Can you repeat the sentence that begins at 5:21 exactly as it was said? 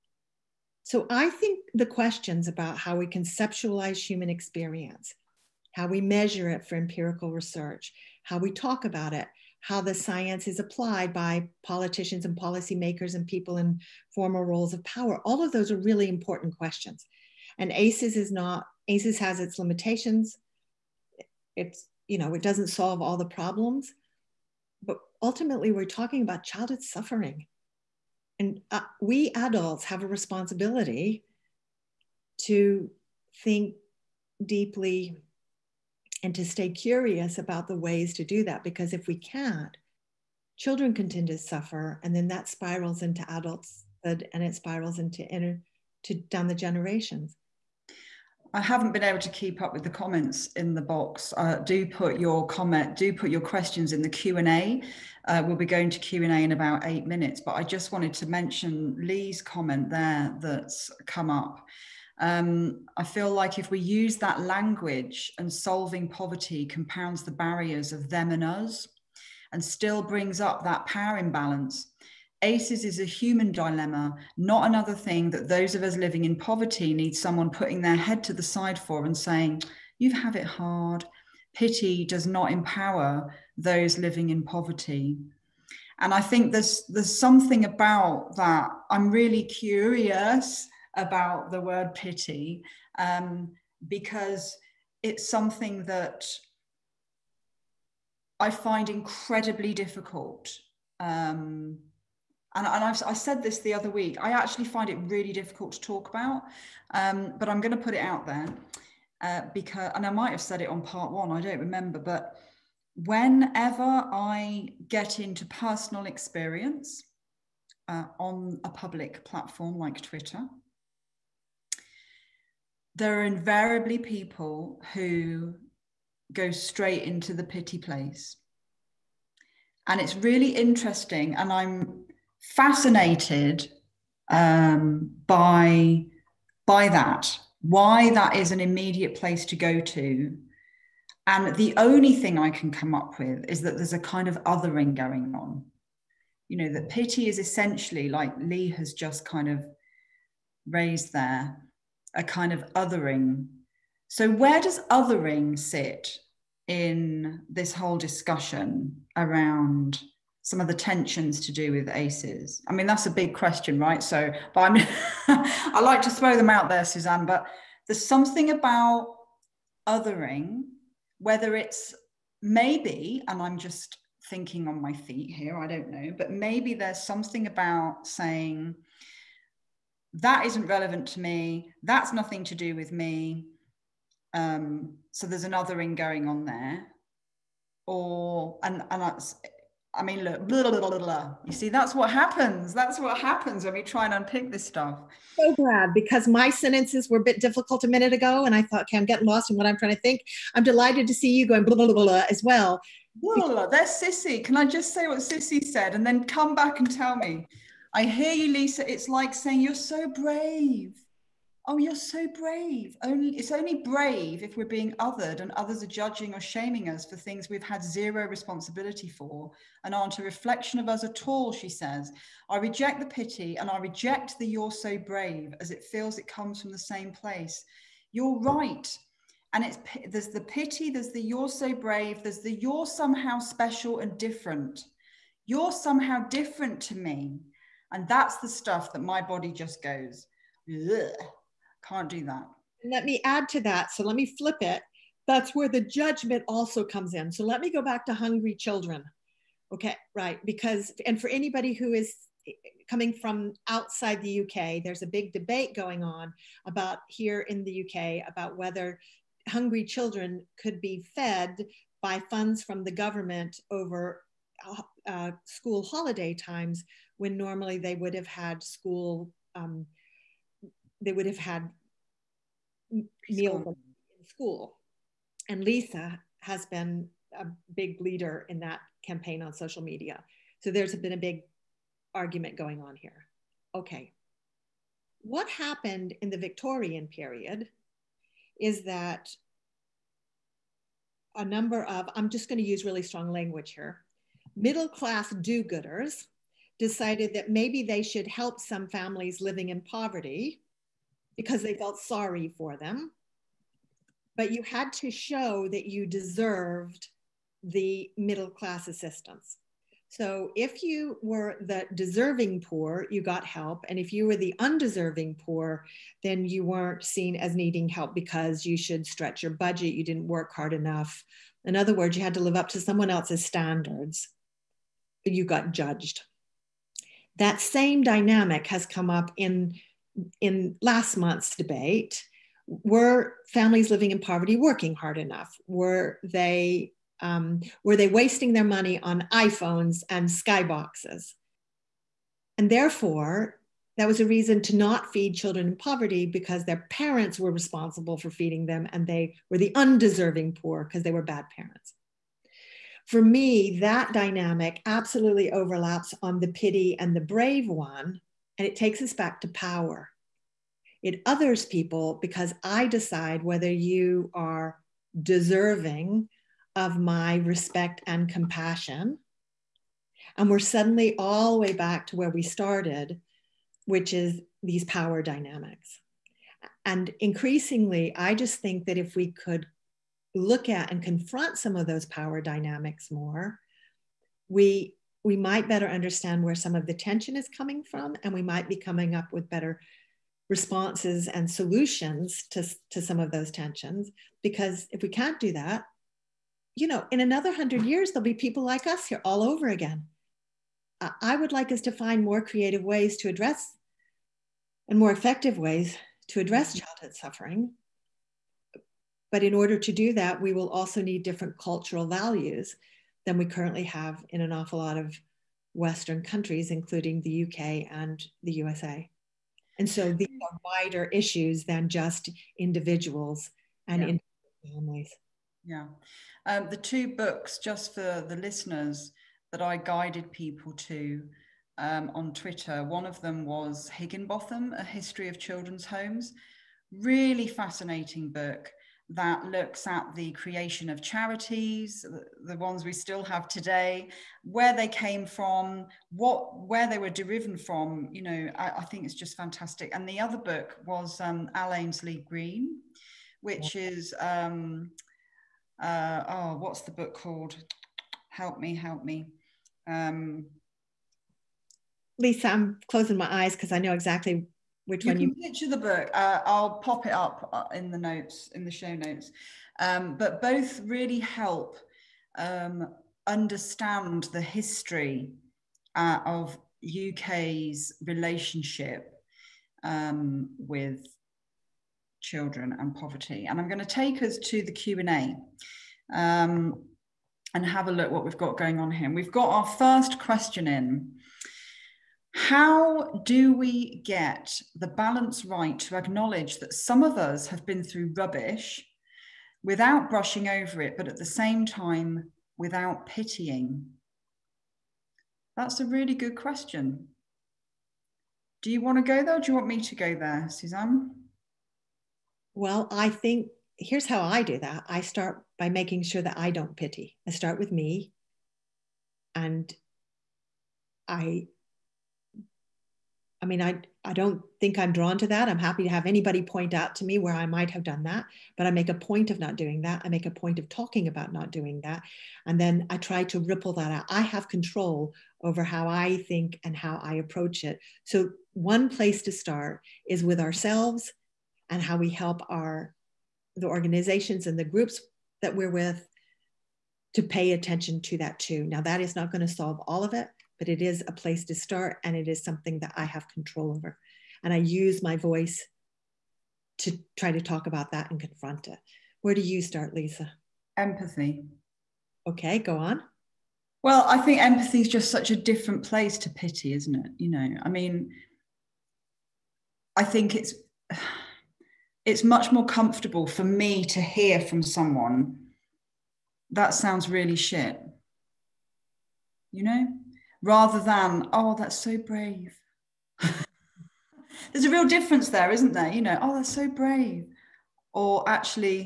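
In other words, you had to live up to someone else's standards.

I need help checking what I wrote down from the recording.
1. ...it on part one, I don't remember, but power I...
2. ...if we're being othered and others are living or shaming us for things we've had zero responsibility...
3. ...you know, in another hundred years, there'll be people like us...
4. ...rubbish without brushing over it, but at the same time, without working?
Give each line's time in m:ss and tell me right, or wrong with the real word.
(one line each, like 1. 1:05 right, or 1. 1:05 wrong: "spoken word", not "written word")
1. 1:50 wrong: "whenever", not "power"
2. 3:34 wrong: "judging", not "living"
3. 6:36 right
4. 8:18 wrong: "pitying", not "working".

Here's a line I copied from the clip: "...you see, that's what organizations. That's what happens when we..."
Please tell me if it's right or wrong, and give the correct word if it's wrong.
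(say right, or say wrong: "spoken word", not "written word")
wrong: "happens", not "organizations".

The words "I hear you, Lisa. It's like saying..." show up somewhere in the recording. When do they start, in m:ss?
3:27.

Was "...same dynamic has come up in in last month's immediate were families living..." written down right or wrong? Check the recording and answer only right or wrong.
wrong.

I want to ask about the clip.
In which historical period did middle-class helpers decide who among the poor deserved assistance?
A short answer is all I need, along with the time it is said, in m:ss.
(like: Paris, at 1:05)
Victorian period, at 4:46.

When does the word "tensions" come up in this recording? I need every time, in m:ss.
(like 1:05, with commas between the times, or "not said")
2:40, 6:26, 6:33.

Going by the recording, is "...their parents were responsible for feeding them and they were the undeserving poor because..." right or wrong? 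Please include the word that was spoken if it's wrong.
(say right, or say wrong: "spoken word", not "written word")
right.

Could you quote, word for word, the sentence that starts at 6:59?
And so these are wider issues than just individuals and yeah.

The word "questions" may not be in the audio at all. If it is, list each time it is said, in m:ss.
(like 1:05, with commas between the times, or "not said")
0:01, 0:16, 0:53, 2:43, 8:10, 8:26.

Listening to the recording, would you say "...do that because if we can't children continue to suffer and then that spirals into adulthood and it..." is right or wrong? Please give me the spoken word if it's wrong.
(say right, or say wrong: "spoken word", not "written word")
right.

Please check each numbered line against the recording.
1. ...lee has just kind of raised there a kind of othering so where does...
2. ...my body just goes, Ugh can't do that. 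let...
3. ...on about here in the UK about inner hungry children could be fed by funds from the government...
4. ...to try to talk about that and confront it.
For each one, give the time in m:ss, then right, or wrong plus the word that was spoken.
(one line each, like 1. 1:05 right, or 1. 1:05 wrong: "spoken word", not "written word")
1. 2:28 right
2. 3:59 right
3. 4:16 wrong: "whether", not "inner"
4. 9:16 right.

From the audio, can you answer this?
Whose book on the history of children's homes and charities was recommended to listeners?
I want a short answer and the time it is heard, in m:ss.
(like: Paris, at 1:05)
Higginbotham, at 7:13.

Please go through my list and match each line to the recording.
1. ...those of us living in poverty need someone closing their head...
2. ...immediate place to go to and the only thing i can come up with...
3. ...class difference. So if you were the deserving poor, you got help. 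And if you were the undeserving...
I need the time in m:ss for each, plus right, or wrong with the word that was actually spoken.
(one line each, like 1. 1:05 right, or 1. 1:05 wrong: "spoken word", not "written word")
1. 1:15 wrong: "putting", not "closing"
2. 2:18 right
3. 5:08 wrong: "assistance", not "difference".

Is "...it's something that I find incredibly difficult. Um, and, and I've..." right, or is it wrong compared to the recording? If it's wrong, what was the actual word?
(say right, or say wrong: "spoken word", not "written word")
right.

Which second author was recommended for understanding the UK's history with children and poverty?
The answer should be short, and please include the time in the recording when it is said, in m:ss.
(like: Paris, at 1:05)
Al Aynsley-Green, at 7:31.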